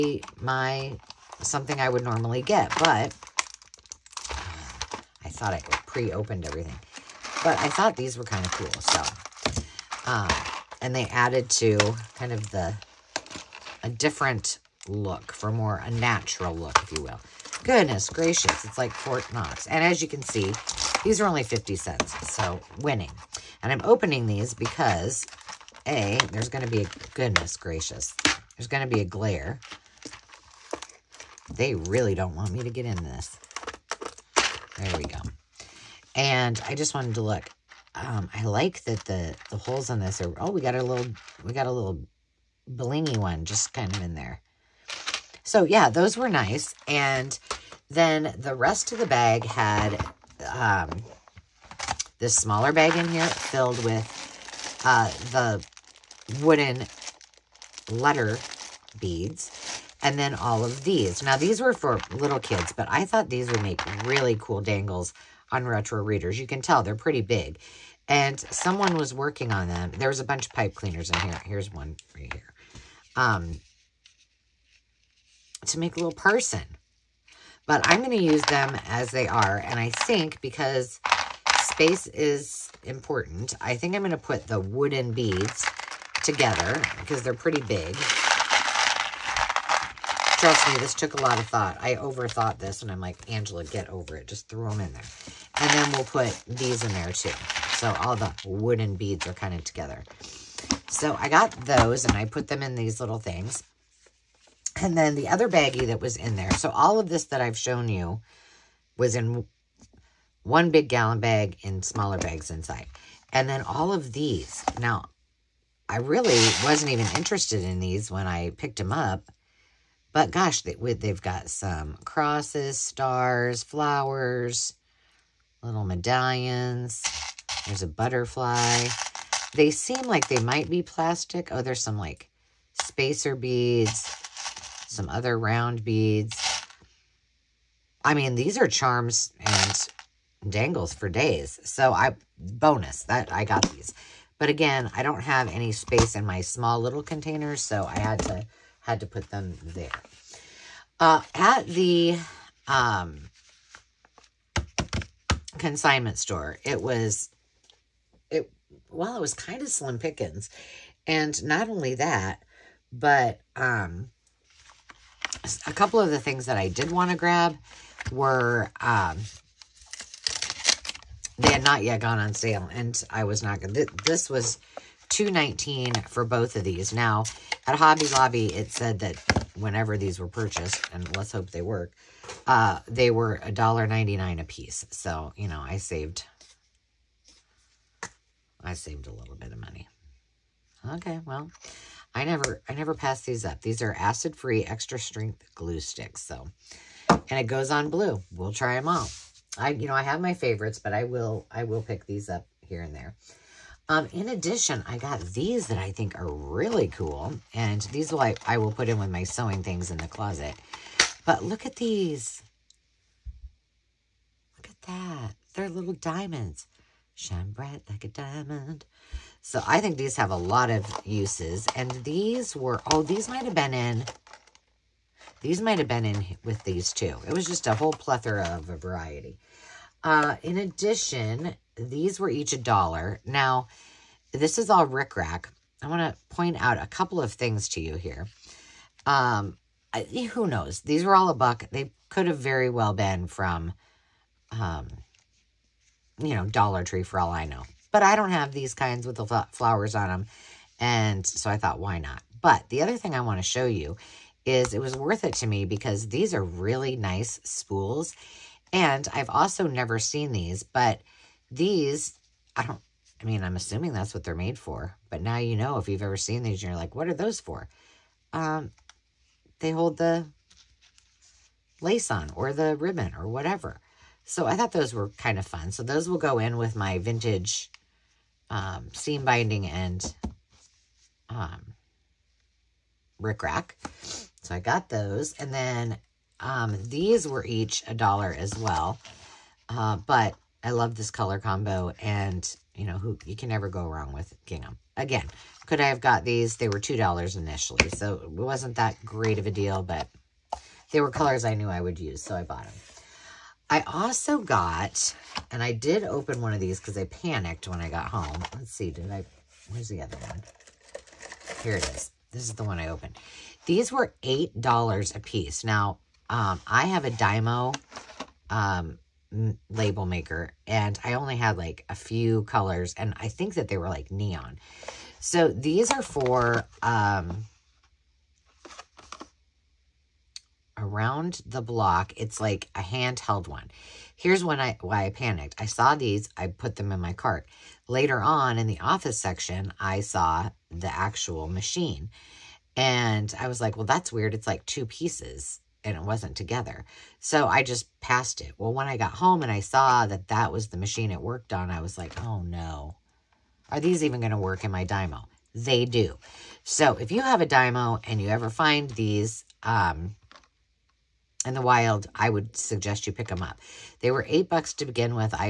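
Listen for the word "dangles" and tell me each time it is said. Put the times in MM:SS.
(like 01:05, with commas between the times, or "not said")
01:04, 02:20.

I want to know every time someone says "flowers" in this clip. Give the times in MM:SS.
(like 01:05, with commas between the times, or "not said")
02:03, 04:09.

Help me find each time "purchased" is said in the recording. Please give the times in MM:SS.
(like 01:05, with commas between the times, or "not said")
03:00.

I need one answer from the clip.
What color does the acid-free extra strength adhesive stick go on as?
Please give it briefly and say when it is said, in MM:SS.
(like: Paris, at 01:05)
Blue, at 03:17.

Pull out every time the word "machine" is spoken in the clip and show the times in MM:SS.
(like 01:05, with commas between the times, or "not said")
05:41, 05:50.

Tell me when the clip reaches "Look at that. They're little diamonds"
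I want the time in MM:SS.
03:34.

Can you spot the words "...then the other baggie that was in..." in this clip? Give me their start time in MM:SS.
01:44.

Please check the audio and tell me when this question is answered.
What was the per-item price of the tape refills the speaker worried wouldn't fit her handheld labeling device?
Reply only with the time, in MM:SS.
05:14.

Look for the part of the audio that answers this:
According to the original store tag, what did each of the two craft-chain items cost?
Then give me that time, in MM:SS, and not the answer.
03:03.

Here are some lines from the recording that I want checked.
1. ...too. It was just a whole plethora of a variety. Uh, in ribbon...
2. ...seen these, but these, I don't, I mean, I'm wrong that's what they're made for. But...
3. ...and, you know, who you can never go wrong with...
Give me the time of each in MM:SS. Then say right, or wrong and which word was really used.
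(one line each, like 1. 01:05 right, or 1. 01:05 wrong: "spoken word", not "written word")
1. 03:46 wrong: "addition", not "ribbon"
2. 04:19 wrong: "assuming", not "wrong"
3. 04:52 right.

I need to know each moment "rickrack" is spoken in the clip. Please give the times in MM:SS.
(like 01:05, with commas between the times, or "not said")
03:54, 04:43.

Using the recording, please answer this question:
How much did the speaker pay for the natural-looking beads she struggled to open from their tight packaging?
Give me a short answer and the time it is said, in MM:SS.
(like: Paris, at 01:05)
50 cents, at 00:21.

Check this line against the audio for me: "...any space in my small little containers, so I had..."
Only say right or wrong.
right.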